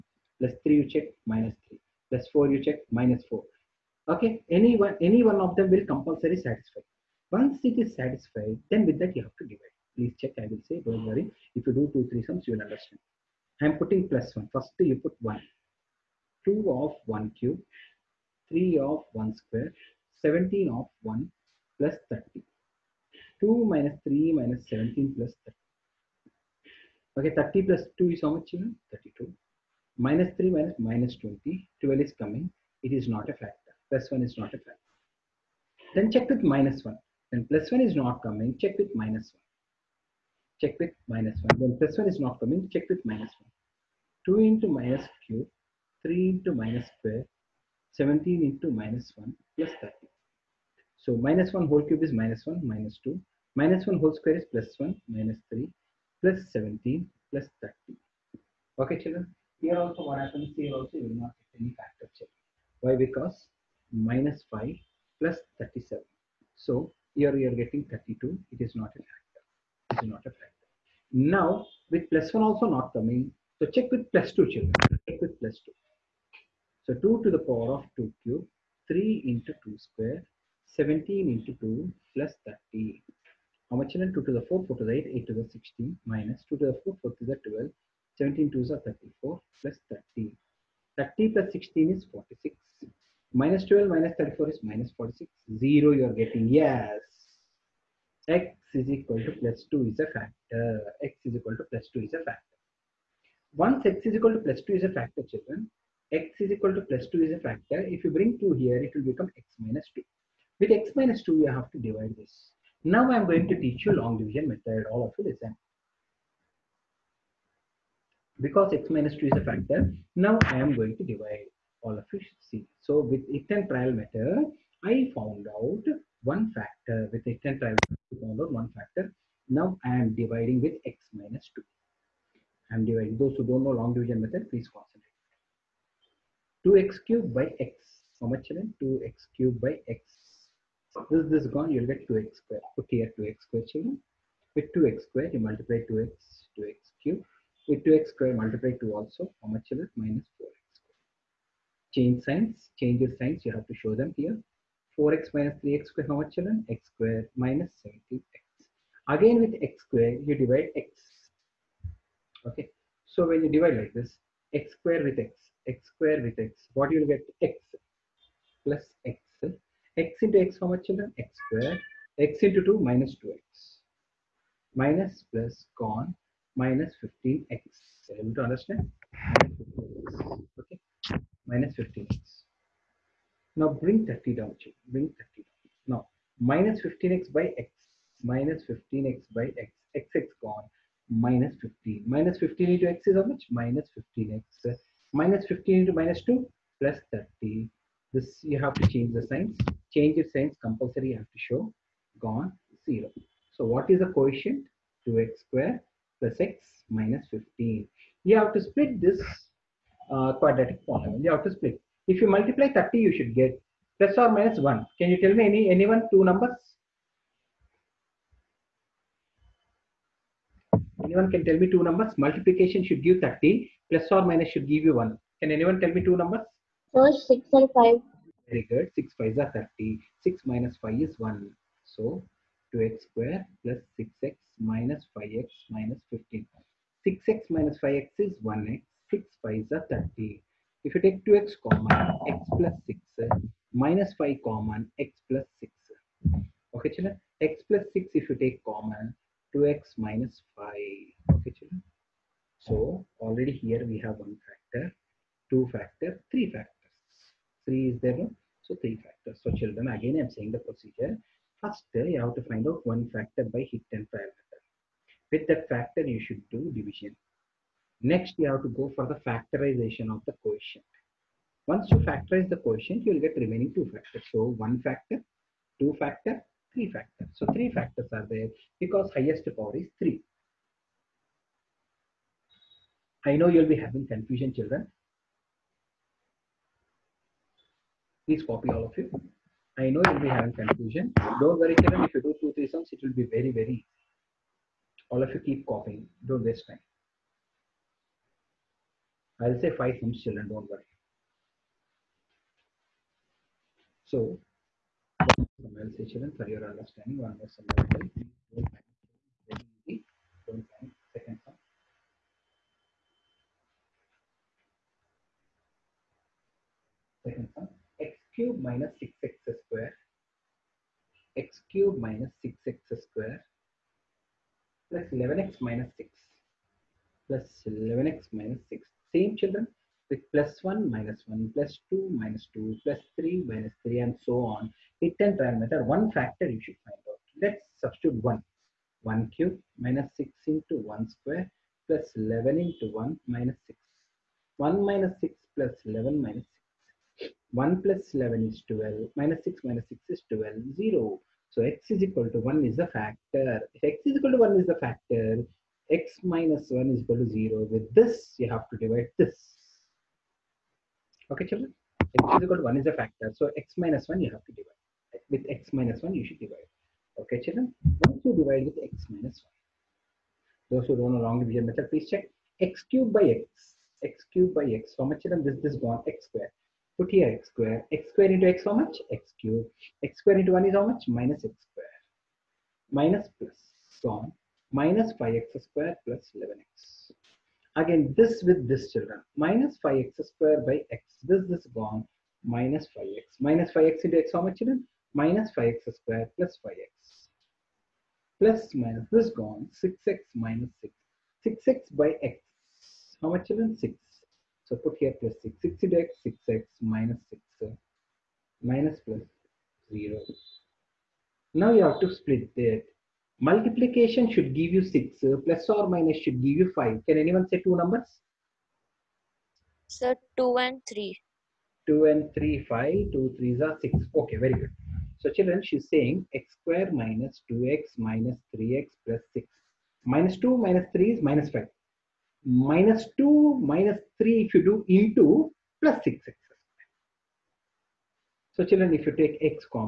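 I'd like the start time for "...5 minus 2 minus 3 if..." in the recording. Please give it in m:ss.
7:11.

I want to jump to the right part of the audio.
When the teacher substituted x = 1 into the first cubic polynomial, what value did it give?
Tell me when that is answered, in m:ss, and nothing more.
0:31.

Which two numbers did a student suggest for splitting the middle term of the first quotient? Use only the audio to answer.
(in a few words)
6 and 5.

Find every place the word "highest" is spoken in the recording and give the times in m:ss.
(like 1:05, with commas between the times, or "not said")
4:39.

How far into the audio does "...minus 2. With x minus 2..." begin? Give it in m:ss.
1:49.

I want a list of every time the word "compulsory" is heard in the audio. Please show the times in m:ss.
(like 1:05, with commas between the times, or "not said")
0:05, 3:20.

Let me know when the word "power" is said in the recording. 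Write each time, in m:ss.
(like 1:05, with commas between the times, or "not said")
1:17, 4:39.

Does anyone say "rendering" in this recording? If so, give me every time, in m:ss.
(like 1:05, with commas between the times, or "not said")
not said.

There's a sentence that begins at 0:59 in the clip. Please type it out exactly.
Here also what happens, here also you will not get any factor check.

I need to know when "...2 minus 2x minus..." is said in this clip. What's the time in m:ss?
2:52.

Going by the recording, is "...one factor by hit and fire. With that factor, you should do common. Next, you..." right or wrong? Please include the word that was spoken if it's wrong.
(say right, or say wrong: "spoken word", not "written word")
wrong: "division", not "common".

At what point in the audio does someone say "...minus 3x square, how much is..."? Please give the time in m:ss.
2:35.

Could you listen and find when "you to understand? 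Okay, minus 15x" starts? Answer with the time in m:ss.
2:58.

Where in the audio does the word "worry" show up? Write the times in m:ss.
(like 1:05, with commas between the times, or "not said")
0:11, 4:51, 5:00.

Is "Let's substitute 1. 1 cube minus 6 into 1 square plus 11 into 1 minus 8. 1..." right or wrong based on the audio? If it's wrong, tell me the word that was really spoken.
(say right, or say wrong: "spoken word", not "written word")
wrong: "6", not "8".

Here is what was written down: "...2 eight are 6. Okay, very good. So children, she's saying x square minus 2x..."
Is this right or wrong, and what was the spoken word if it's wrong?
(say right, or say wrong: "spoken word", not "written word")
wrong: "three", not "eight".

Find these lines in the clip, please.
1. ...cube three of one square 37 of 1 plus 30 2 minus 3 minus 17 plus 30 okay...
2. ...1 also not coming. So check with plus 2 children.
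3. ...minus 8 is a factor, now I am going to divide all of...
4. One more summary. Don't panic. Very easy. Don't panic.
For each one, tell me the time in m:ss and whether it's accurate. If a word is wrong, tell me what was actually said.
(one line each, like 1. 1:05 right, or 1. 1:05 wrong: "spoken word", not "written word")
1. 0:17 wrong: "17", not "37"
2. 1:12 right
3. 1:58 wrong: "2", not "8"
4. 5:07 right.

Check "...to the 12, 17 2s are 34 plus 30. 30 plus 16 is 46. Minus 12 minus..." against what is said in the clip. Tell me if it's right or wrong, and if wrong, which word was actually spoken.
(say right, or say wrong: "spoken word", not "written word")
right.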